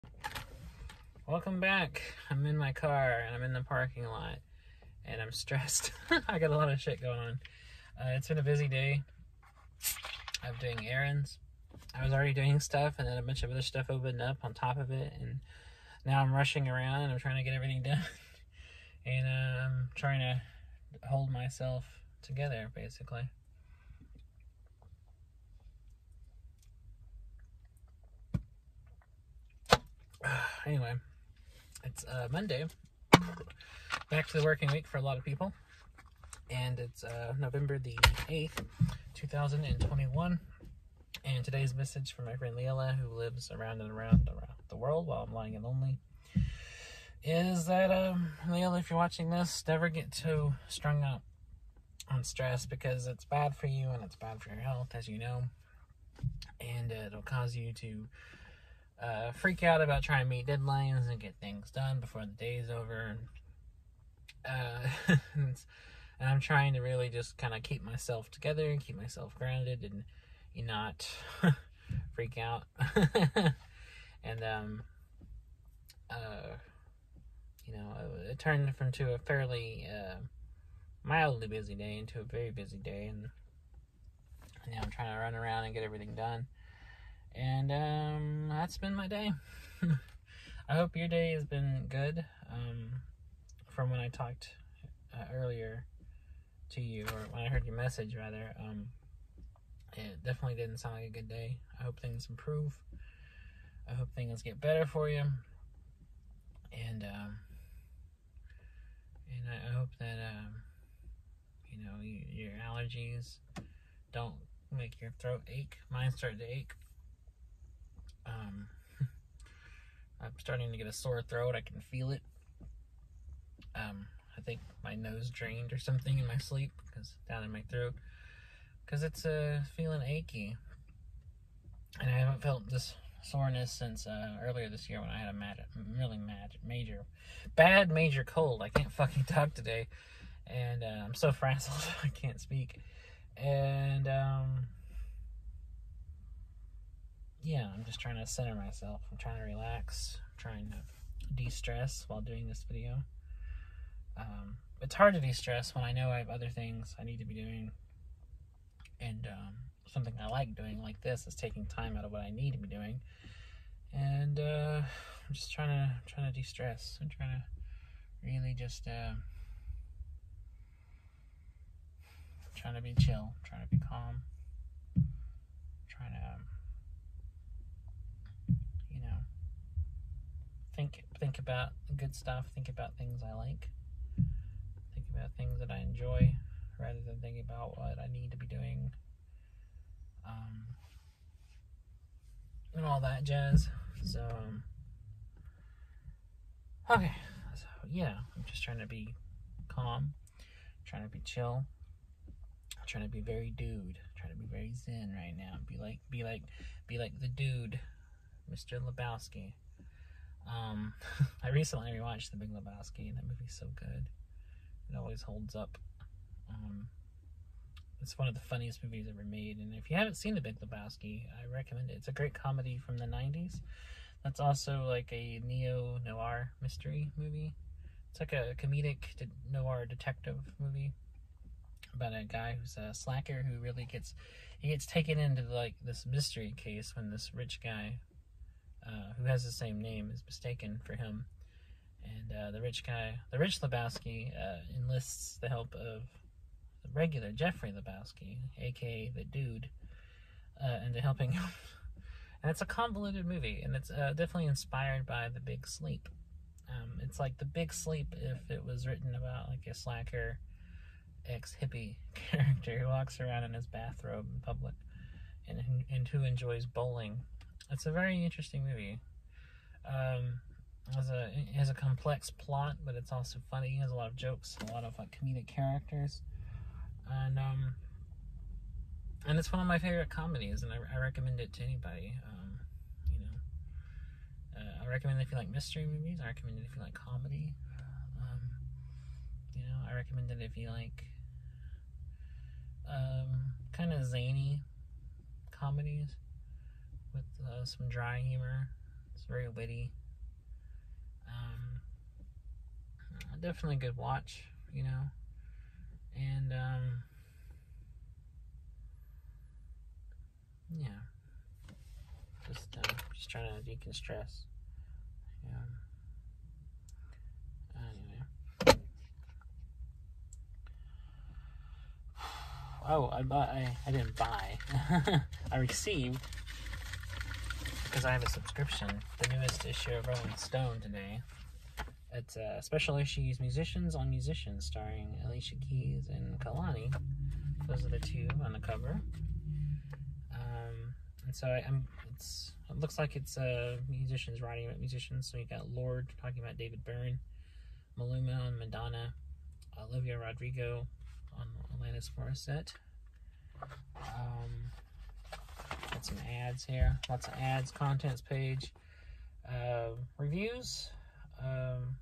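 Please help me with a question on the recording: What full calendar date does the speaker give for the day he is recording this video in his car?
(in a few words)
November 8, 2021.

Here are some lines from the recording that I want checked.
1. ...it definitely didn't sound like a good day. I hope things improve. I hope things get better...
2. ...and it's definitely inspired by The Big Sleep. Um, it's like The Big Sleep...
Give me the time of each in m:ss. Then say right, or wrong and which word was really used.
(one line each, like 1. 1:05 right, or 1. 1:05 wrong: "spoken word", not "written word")
1. 1:39 right
2. 4:13 right.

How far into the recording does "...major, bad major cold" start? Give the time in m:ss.
2:16.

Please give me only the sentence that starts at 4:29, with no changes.
Um, has a it has a complex plot, but it's also funny.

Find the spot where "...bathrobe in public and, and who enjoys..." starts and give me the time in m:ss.
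4:23.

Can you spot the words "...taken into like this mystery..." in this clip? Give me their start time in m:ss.
3:54.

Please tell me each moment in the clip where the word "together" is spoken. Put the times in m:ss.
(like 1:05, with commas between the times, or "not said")
0:22, 1:08.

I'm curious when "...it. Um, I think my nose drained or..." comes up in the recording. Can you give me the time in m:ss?
2:02.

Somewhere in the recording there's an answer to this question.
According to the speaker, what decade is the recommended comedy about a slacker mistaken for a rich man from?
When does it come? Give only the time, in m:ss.
3:42.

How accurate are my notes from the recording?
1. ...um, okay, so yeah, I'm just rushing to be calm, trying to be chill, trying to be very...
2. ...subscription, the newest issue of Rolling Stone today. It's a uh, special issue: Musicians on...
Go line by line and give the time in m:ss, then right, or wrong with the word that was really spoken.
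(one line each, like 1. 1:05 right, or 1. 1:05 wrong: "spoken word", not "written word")
1. 3:14 wrong: "trying", not "rushing"
2. 5:28 right.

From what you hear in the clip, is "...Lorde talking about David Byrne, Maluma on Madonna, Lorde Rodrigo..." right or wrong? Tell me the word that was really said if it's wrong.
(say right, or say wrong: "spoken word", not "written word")
wrong: "Olivia", not "Lorde".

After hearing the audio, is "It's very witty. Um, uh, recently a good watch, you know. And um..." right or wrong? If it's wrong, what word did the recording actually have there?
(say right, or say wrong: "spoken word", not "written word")
wrong: "definitely", not "recently".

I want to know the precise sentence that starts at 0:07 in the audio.
Uh, it's been a busy day of doing errands.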